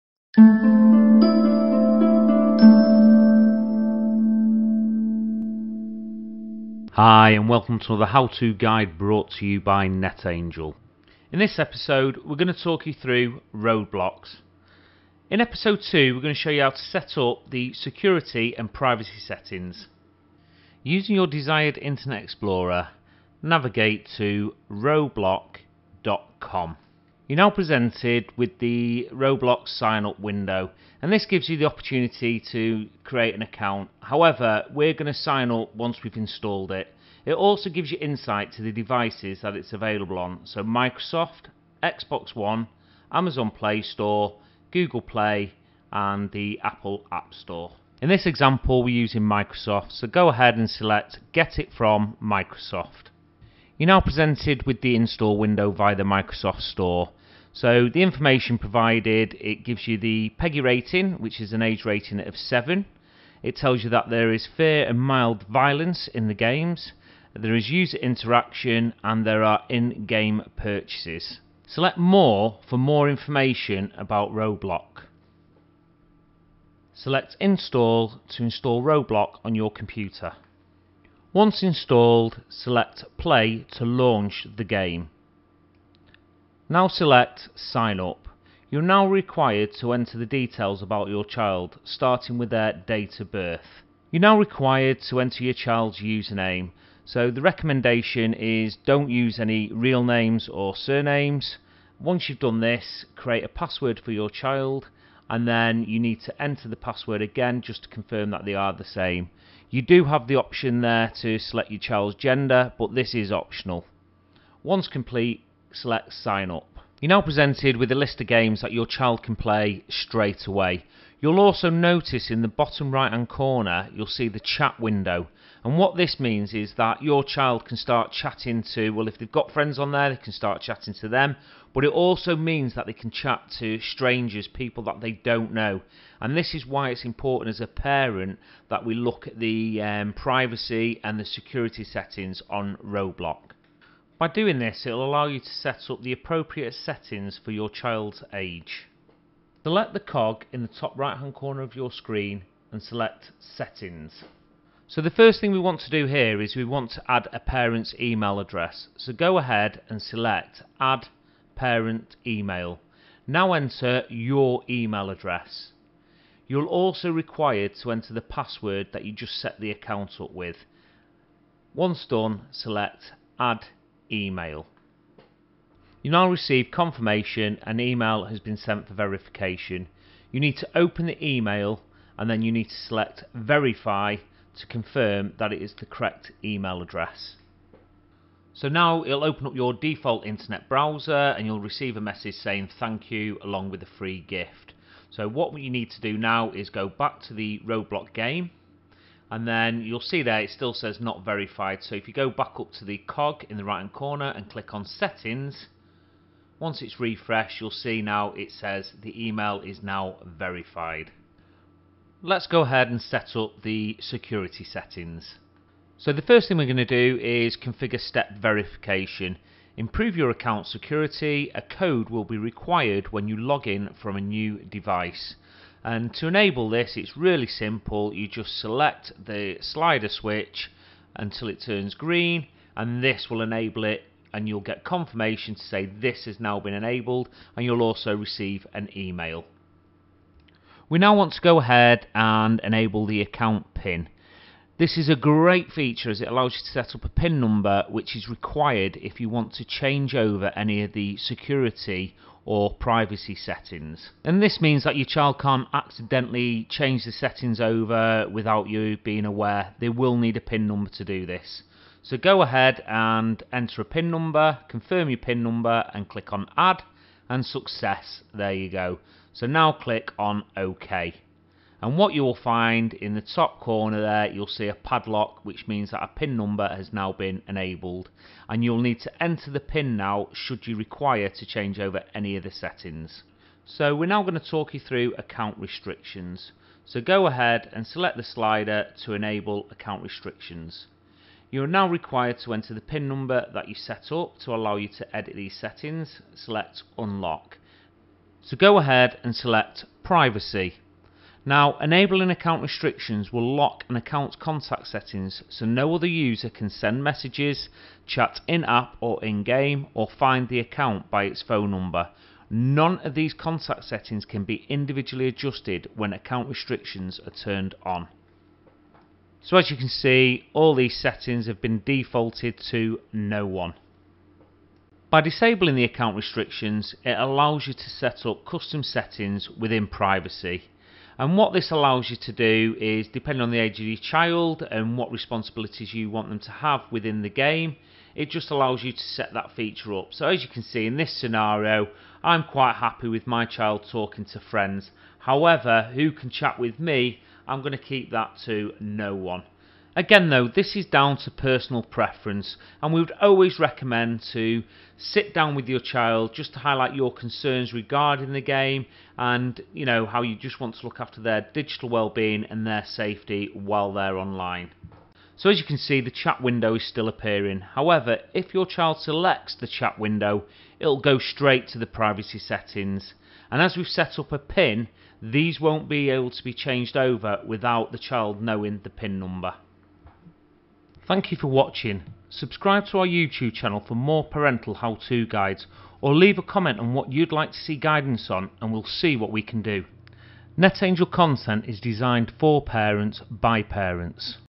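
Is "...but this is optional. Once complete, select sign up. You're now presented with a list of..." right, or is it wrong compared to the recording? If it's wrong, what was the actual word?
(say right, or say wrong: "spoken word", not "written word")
right.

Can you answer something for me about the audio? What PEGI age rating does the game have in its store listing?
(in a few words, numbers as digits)
7.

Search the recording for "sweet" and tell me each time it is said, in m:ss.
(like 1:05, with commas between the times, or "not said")
not said.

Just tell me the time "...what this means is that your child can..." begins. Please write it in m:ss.
2:05.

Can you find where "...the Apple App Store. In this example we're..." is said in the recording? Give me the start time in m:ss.
0:46.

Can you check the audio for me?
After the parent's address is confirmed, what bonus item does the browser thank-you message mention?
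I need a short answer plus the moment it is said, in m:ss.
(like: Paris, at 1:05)
a free gift, at 3:13.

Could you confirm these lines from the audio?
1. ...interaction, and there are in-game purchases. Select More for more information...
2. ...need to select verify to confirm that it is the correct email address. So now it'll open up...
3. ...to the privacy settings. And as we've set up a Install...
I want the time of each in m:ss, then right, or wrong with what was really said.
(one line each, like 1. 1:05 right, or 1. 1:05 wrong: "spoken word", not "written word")
1. 1:07 right
2. 3:02 right
3. 6:11 wrong: "PIN", not "Install".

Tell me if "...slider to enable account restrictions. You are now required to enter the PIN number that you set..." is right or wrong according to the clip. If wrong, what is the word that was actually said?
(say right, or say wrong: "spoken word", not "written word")
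right.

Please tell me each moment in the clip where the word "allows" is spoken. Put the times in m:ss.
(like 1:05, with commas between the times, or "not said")
2:25, 4:06, 4:54, 5:27, 5:31, 5:38.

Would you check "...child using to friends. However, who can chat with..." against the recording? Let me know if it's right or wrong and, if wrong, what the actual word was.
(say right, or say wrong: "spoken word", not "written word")
wrong: "talking", not "using".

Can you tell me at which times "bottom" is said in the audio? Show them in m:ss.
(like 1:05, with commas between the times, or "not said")
2:02.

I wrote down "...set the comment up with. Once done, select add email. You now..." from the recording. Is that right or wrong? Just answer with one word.
wrong.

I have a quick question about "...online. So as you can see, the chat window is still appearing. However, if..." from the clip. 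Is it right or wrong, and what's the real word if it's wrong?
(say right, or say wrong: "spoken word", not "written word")
right.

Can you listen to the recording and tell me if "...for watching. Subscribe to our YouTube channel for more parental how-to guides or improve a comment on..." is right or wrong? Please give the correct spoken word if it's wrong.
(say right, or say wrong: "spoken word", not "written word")
wrong: "leave", not "improve".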